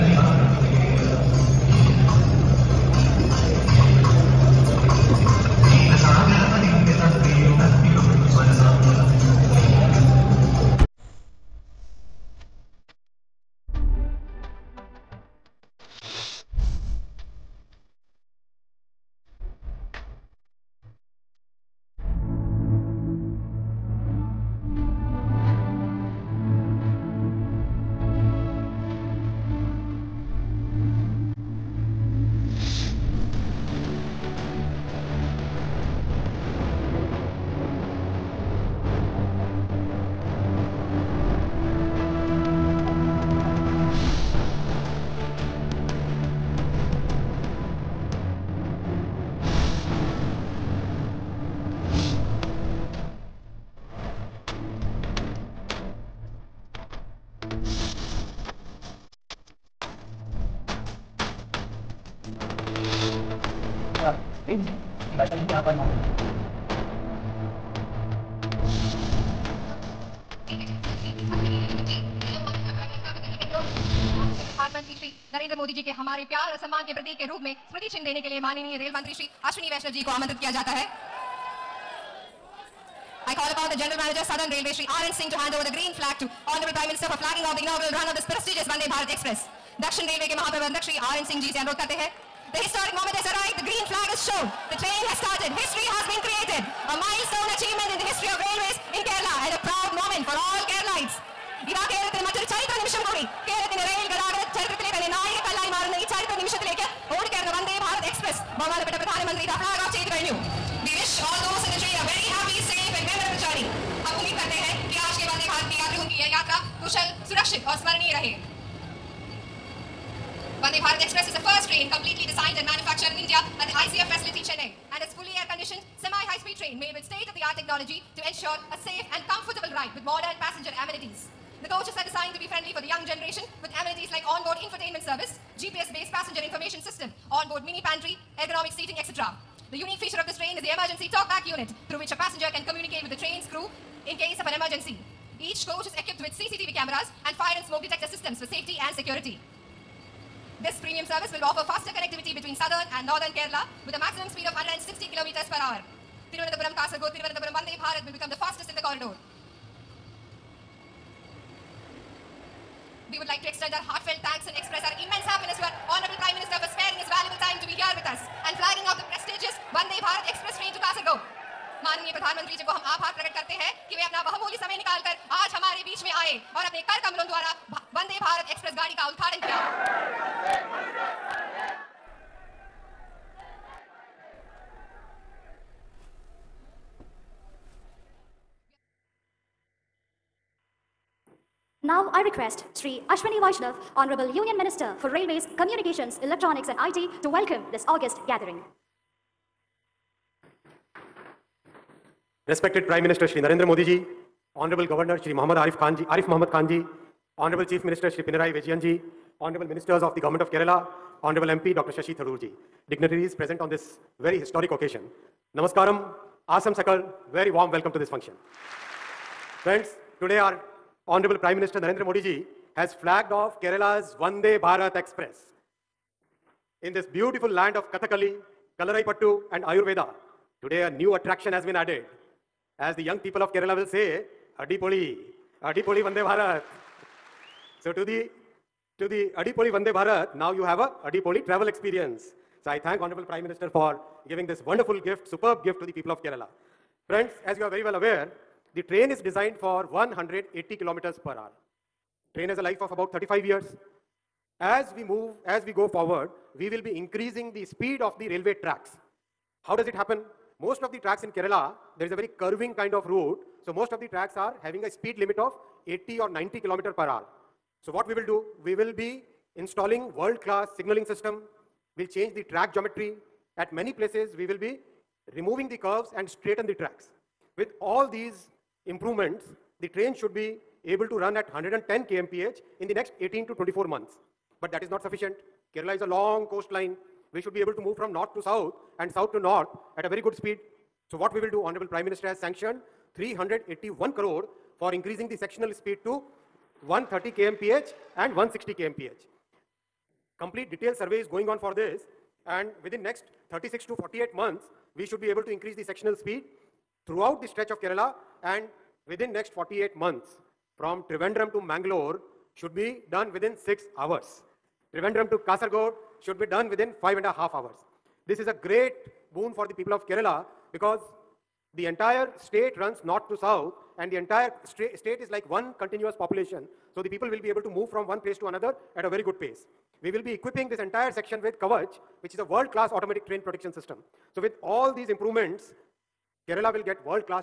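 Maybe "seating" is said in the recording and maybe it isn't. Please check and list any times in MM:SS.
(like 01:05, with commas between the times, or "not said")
02:18.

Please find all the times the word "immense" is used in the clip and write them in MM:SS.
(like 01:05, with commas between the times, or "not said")
02:45.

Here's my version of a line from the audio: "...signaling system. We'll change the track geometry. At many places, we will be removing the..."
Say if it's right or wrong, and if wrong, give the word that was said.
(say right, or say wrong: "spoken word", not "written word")
right.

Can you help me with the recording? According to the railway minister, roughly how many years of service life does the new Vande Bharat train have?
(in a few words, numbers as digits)
35 years.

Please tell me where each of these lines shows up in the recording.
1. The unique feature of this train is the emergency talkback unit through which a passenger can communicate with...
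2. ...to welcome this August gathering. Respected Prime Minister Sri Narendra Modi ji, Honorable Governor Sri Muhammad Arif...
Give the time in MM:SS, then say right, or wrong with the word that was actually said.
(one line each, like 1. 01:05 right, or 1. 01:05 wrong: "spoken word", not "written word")
1. 02:19 right
2. 03:17 right.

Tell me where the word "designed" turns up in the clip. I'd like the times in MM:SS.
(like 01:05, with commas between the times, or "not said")
02:02, 02:12, 04:09.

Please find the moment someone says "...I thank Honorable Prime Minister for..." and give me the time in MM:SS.
04:02.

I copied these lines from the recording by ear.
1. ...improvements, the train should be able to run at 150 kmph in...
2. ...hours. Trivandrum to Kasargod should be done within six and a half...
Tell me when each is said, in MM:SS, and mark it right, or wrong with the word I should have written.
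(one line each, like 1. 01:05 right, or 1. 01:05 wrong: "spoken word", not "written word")
1. 04:38 wrong: "110", not "150"
2. 05:13 wrong: "five", not "six".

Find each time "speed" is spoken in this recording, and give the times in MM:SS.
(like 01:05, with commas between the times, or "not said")
02:05, 02:34, 04:17, 04:24, 04:50, 04:55, 05:06.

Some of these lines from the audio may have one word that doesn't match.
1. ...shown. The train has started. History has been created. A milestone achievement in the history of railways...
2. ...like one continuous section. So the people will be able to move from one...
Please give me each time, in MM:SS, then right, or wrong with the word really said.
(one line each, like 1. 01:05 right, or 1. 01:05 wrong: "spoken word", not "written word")
1. 01:34 right
2. 05:25 wrong: "population", not "section".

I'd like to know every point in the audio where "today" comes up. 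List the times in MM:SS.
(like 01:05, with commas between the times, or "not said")
03:40, 03:50.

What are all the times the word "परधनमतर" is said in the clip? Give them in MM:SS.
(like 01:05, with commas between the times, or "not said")
01:04, 02:52.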